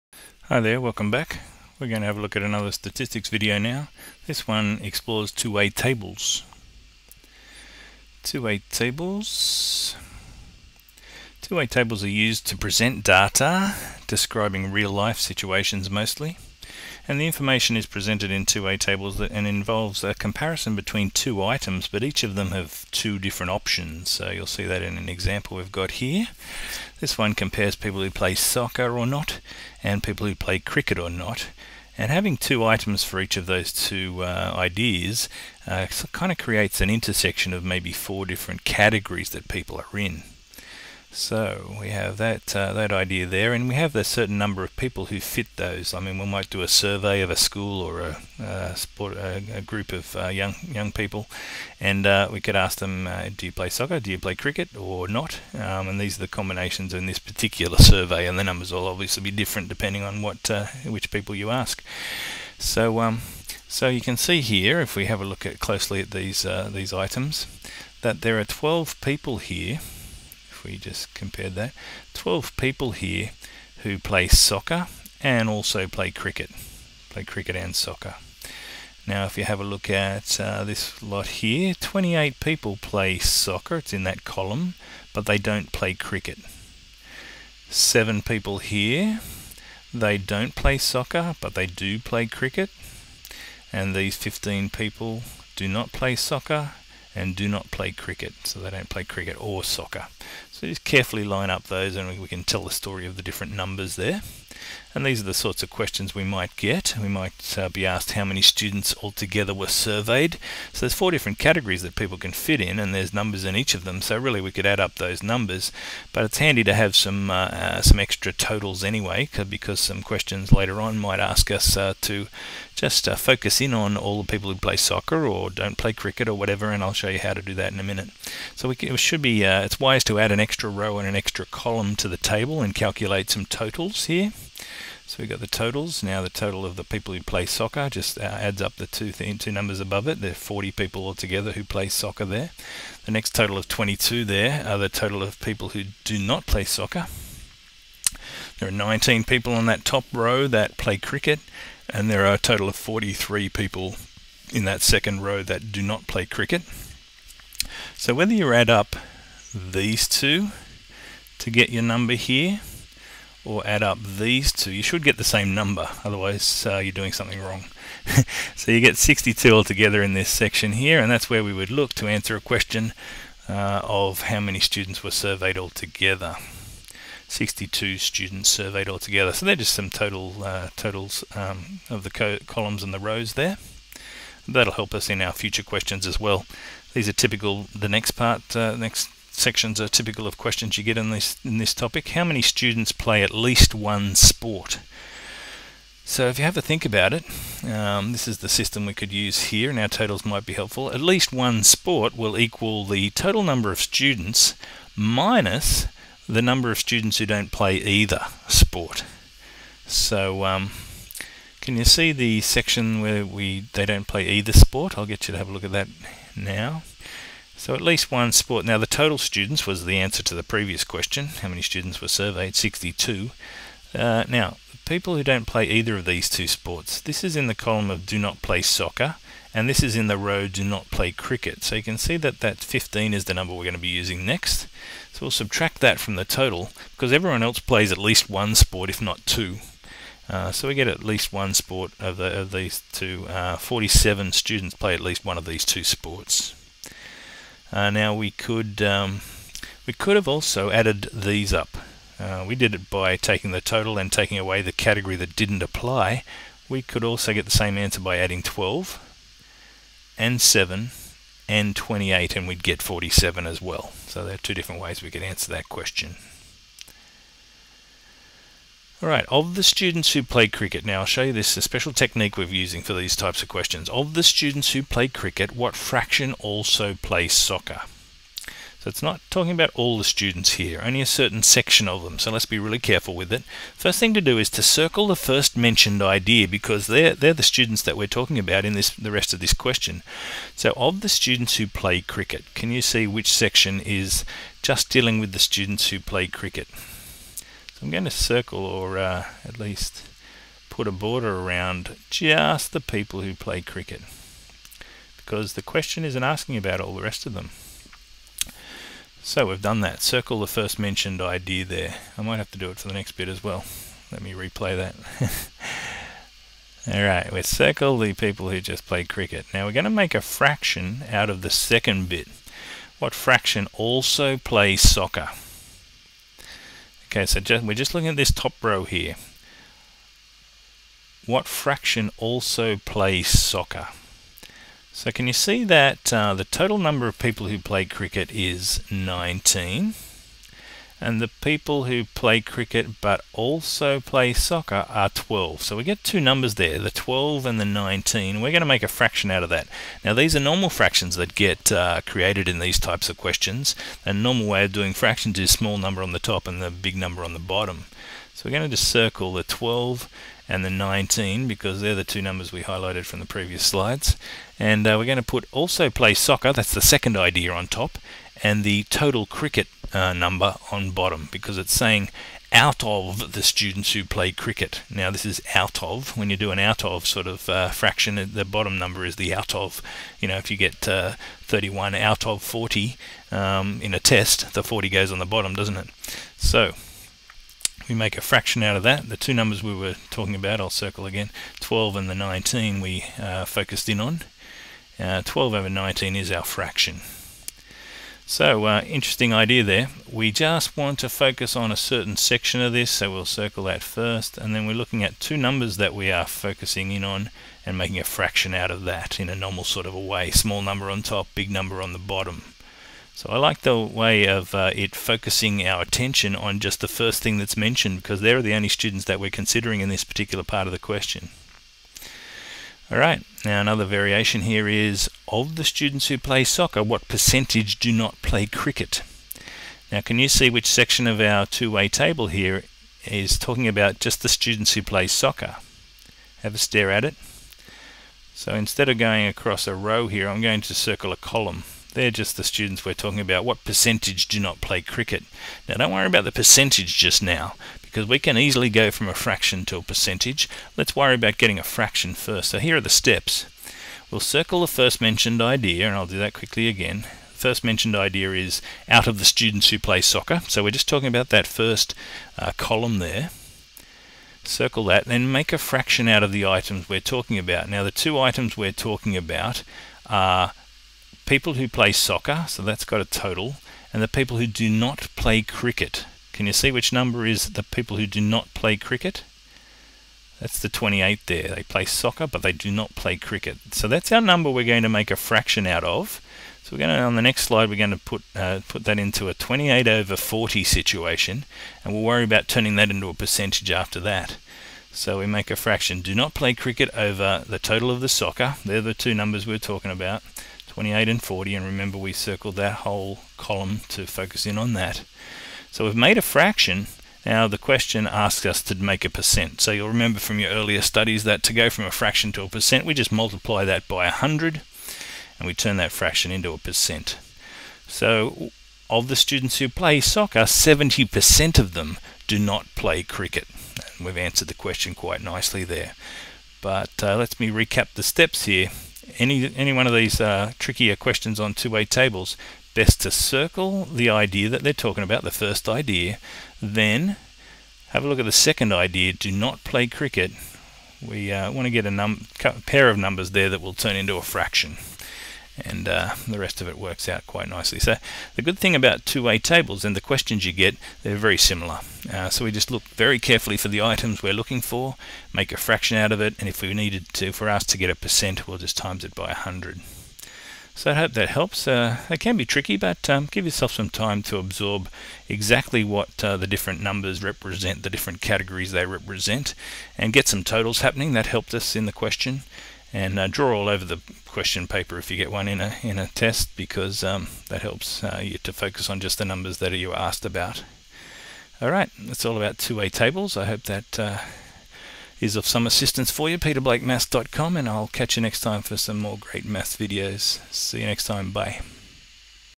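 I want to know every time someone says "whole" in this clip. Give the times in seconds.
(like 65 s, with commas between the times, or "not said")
502 s.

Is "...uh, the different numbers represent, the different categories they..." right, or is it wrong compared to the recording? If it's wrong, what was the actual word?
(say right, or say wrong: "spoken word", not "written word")
right.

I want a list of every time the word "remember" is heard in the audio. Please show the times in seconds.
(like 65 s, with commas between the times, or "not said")
501 s, 509 s.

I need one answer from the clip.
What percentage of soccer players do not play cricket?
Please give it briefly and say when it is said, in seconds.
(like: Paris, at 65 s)
70%, at 520 s.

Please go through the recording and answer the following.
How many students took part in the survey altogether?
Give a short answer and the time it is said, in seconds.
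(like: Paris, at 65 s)
62, at 177 s.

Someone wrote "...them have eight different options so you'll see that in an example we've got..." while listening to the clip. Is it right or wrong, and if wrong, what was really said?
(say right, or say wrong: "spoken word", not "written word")
wrong: "two", not "eight".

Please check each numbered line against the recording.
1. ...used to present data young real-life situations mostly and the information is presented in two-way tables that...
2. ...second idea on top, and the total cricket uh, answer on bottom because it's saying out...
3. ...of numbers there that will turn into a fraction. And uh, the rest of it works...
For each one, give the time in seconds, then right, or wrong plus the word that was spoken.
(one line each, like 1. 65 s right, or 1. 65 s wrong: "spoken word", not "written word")
1. 12 s wrong: "describing", not "young"
2. 366 s wrong: "number", not "answer"
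3. 542 s right.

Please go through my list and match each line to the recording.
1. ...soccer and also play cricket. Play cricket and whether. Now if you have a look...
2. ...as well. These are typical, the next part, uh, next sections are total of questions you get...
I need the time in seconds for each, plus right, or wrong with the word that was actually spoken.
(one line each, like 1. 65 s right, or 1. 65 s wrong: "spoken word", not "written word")
1. 74 s wrong: "soccer", not "whether"
2. 186 s wrong: "typical", not "total".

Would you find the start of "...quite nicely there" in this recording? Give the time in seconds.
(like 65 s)
524 s.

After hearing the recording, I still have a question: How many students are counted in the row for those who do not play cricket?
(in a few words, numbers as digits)
43.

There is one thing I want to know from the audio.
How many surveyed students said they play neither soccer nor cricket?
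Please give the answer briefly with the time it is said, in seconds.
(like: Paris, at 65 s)
15, at 93 s.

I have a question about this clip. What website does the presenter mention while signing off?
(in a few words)
peterblakemaths.com.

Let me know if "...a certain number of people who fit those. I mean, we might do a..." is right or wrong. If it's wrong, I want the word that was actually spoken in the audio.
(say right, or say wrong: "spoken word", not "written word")
right.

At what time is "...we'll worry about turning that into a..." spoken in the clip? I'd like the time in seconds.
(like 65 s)
491 s.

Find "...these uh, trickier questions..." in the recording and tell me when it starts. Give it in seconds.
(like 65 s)
529 s.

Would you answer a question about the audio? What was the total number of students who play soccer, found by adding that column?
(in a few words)
40.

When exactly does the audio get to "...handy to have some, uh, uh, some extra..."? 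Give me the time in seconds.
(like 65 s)
116 s.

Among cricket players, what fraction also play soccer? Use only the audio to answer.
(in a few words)
12/19.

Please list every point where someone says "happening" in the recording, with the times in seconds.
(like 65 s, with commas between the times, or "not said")
570 s.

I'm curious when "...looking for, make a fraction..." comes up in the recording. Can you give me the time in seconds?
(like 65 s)
554 s.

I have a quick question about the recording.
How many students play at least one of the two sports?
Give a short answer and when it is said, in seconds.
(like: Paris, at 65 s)
47, at 243 s.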